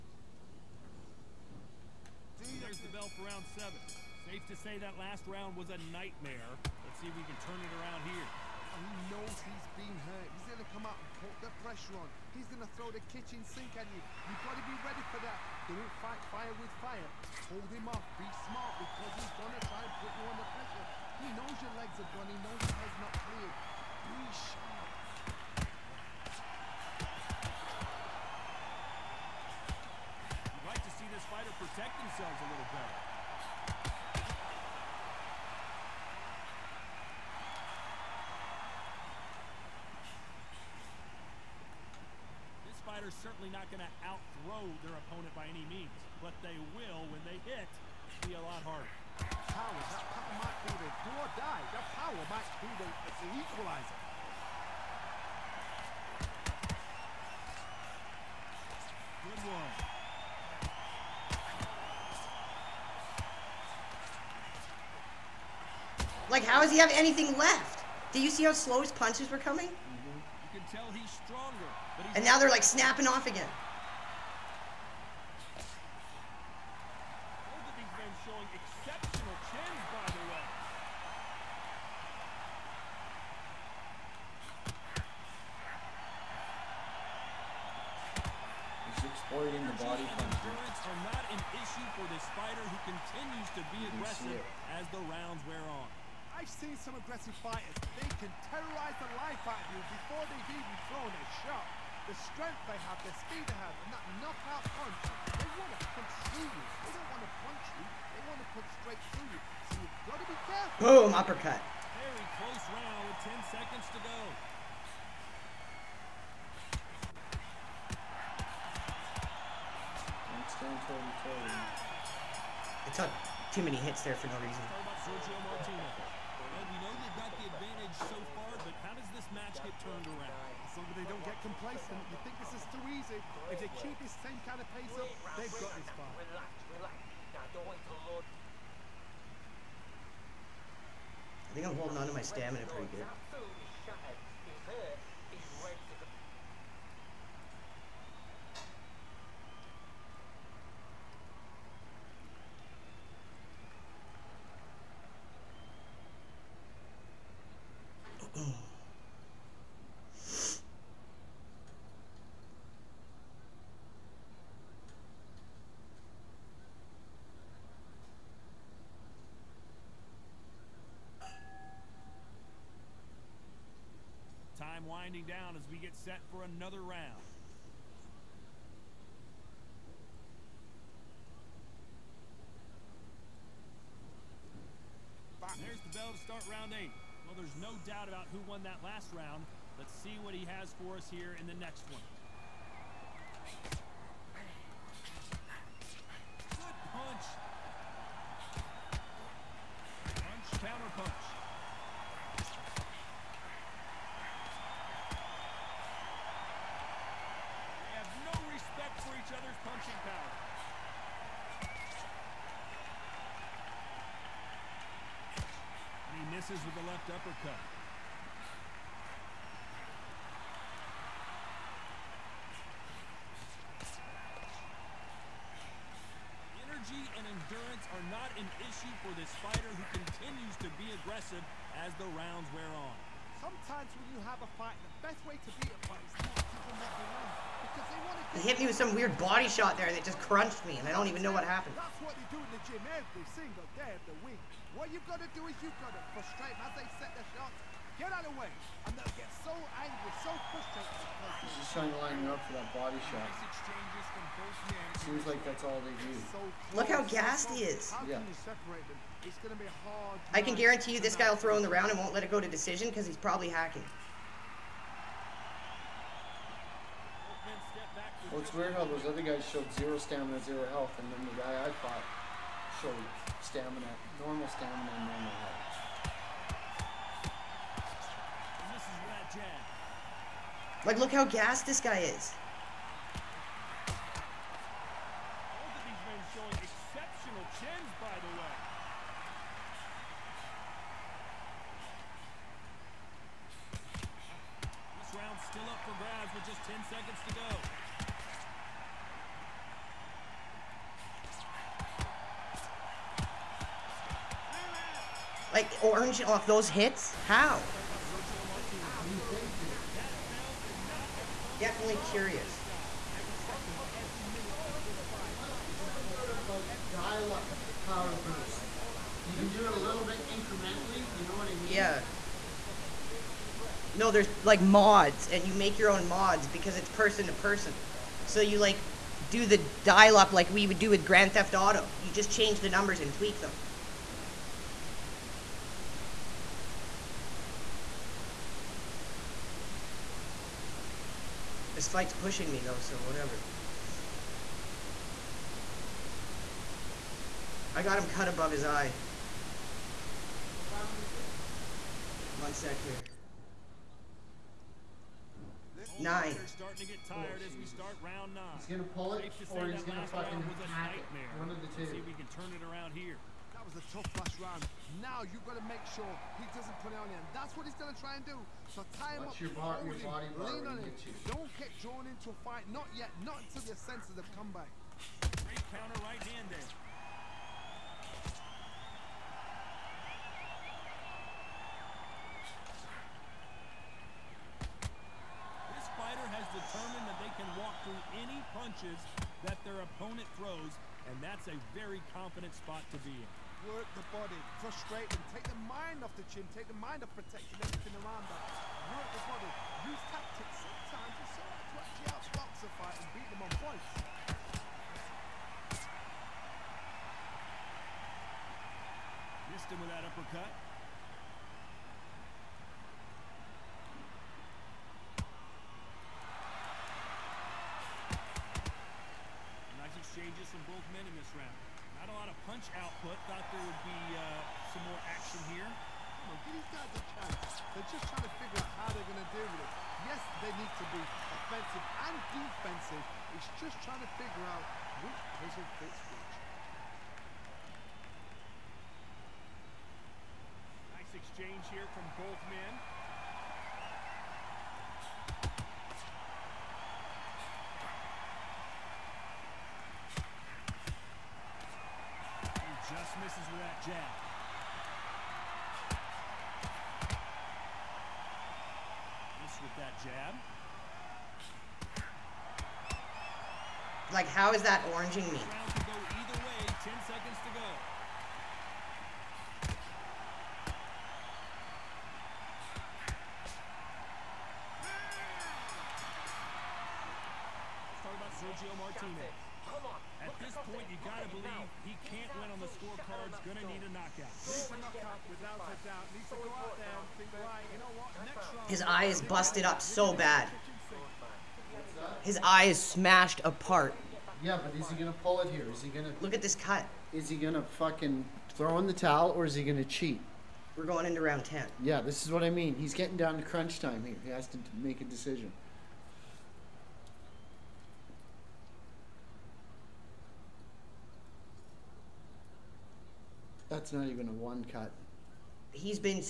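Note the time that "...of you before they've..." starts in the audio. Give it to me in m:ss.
1:39.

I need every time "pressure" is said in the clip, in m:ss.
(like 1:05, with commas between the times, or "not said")
0:11, 0:20.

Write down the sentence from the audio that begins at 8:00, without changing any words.
point, you got to believe he can't win on the scorecard's going to need a knockout.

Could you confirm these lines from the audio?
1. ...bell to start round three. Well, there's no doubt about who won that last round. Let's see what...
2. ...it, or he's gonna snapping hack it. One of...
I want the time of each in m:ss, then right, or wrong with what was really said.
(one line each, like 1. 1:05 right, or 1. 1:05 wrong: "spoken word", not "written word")
1. 3:05 wrong: "eight", not "three"
2. 5:59 wrong: "fucking", not "snapping".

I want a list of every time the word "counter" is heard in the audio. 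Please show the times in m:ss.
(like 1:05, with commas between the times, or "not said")
6:15.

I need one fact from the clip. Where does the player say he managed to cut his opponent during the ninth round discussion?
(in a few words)
above his eye.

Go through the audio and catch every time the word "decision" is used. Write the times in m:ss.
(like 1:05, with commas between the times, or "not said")
4:22, 8:25.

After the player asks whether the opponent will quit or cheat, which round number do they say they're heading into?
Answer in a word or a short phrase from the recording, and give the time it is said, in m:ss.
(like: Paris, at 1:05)
10, at 8:21.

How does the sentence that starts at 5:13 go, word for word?
Every minute of this fight You can do it a little bit incrementally.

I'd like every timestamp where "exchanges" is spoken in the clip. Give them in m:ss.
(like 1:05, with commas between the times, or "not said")
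7:00, 7:21.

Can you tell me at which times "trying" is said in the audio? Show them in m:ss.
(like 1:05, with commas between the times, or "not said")
4:11, 7:08, 7:13.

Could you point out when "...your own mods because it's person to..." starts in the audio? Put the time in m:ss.
5:25.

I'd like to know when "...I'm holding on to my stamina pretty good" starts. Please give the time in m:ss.
2:21.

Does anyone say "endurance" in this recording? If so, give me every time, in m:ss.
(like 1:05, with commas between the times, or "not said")
3:47.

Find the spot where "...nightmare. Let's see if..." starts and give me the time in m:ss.
0:05.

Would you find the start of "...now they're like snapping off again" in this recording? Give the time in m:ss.
1:12.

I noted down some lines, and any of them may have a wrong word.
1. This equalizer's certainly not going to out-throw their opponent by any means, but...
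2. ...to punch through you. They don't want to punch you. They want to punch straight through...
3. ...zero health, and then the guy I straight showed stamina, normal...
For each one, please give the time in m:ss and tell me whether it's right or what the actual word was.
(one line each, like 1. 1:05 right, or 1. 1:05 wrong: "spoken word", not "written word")
1. 0:42 wrong: "fighter", not "equalizer"
2. 1:45 right
3. 4:30 wrong: "fought", not "straight".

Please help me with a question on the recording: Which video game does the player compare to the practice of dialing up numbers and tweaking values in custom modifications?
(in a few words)
Grand Theft Auto.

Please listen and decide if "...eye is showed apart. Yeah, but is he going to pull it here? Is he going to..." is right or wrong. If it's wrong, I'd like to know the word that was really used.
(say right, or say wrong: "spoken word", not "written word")
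wrong: "smashed", not "showed".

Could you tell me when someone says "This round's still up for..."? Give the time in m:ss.
4:55.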